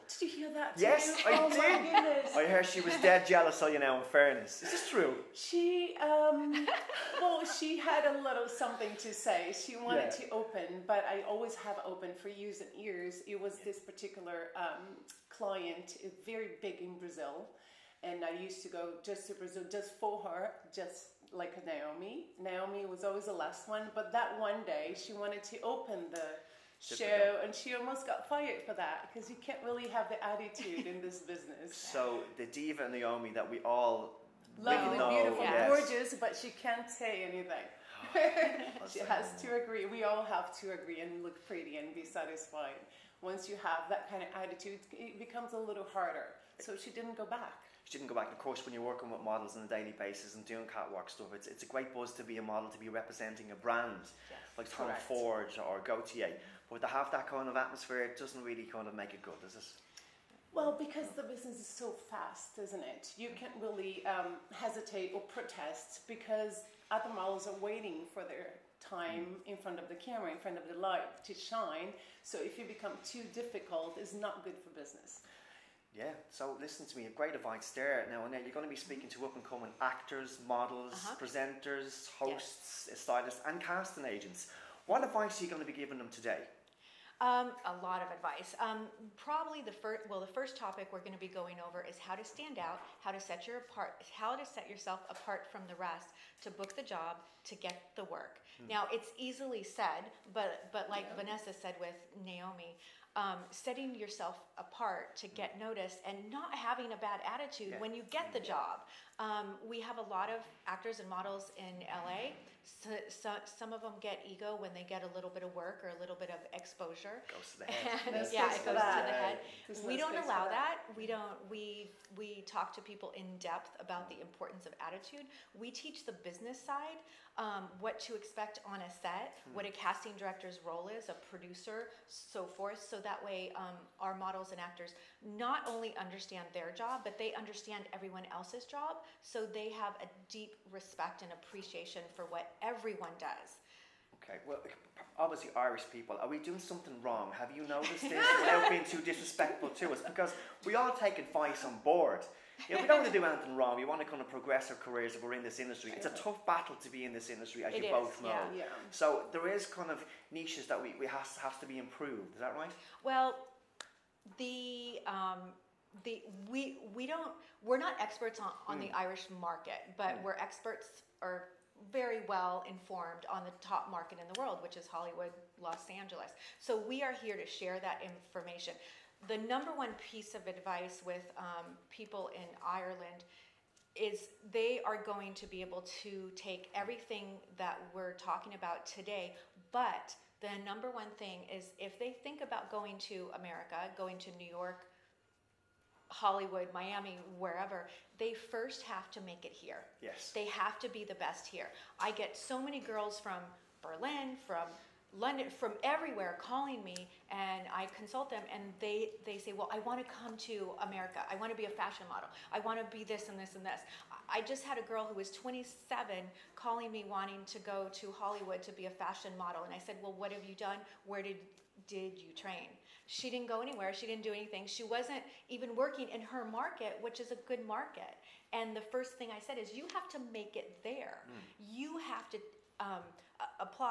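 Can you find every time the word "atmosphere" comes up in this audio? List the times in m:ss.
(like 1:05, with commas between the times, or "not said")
0:57.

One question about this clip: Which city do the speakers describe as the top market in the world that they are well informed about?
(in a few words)
Los Angeles.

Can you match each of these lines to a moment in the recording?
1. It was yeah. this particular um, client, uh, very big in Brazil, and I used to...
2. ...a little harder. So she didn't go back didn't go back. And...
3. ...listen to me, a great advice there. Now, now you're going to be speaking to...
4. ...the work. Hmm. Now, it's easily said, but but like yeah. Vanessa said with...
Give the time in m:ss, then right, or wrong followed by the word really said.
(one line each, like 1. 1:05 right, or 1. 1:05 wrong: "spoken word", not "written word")
1. 0:13 right
2. 0:45 right
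3. 1:16 right
4. 1:37 right.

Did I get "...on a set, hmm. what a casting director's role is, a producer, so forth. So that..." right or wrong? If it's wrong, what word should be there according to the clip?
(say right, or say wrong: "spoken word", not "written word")
right.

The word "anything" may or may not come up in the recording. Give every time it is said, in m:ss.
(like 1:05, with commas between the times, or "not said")
0:37, 2:33, 3:44.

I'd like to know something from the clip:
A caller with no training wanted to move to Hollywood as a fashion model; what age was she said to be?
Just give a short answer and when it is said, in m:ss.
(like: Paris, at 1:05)
27, at 3:35.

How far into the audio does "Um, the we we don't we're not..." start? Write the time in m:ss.
2:45.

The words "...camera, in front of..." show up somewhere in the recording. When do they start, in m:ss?
1:09.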